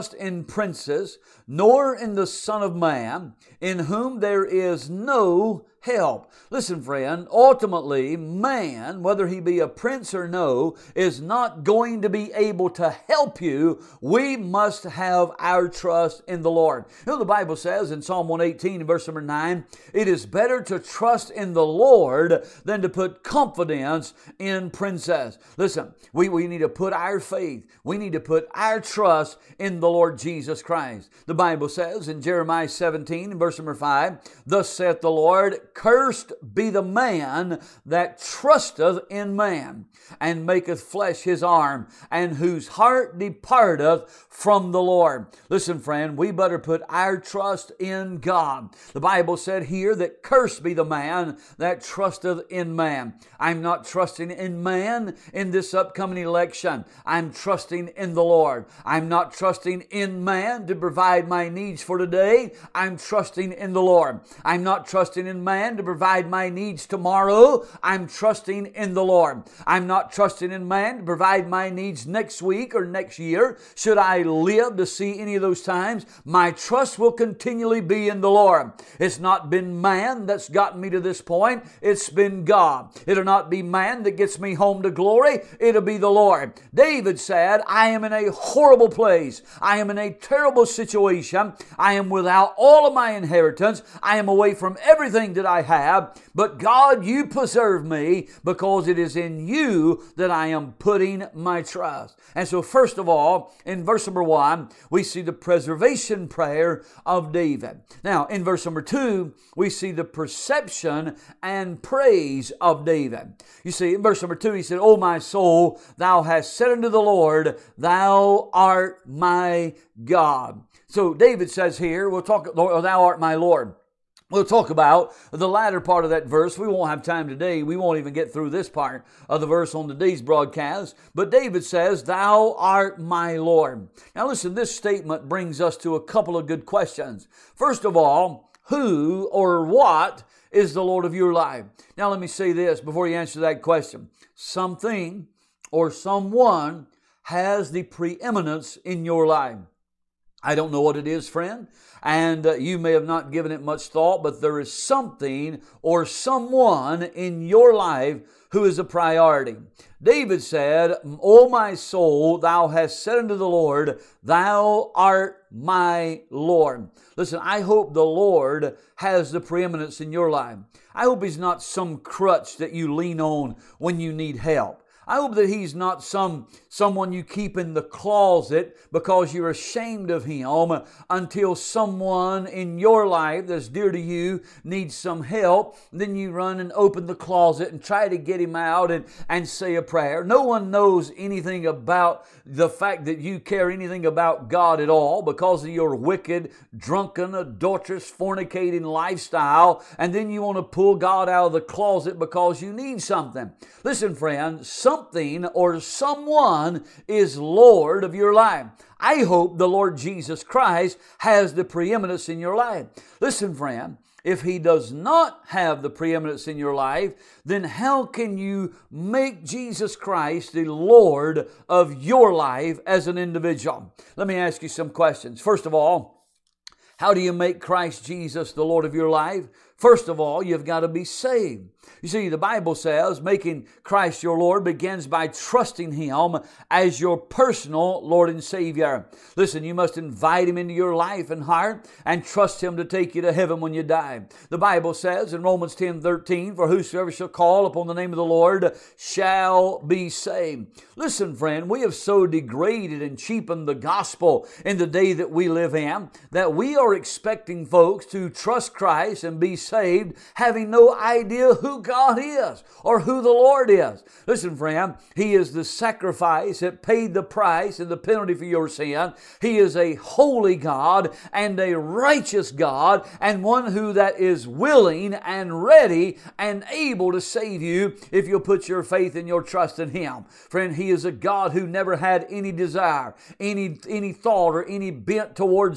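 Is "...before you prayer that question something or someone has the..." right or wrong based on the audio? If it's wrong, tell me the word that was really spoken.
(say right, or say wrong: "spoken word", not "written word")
wrong: "answer", not "prayer".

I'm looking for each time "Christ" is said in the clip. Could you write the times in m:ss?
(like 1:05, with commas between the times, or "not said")
0:30, 3:30, 3:39, 3:47, 3:53, 4:18.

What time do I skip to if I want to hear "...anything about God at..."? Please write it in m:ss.
3:13.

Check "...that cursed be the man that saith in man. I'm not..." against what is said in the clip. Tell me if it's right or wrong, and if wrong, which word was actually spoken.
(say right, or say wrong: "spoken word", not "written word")
wrong: "trusteth", not "saith".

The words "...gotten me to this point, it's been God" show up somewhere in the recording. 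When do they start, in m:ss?
1:20.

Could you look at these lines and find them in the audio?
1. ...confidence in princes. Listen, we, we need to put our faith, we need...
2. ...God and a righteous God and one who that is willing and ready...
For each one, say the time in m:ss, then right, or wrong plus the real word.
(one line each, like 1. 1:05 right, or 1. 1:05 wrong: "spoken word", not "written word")
1. 0:23 right
2. 4:30 right.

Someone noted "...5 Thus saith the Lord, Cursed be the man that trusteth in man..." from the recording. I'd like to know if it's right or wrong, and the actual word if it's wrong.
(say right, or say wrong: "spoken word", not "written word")
right.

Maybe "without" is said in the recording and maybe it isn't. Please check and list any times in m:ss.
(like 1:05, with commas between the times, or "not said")
1:32.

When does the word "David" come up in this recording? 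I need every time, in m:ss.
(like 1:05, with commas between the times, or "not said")
1:26, 1:47, 1:52, 2:01, 2:11, 2:40.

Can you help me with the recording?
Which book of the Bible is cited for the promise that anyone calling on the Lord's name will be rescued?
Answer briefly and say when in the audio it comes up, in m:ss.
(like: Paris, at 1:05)
Romans, at 4:05.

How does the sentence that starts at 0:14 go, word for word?
We must have our trust in the Lord.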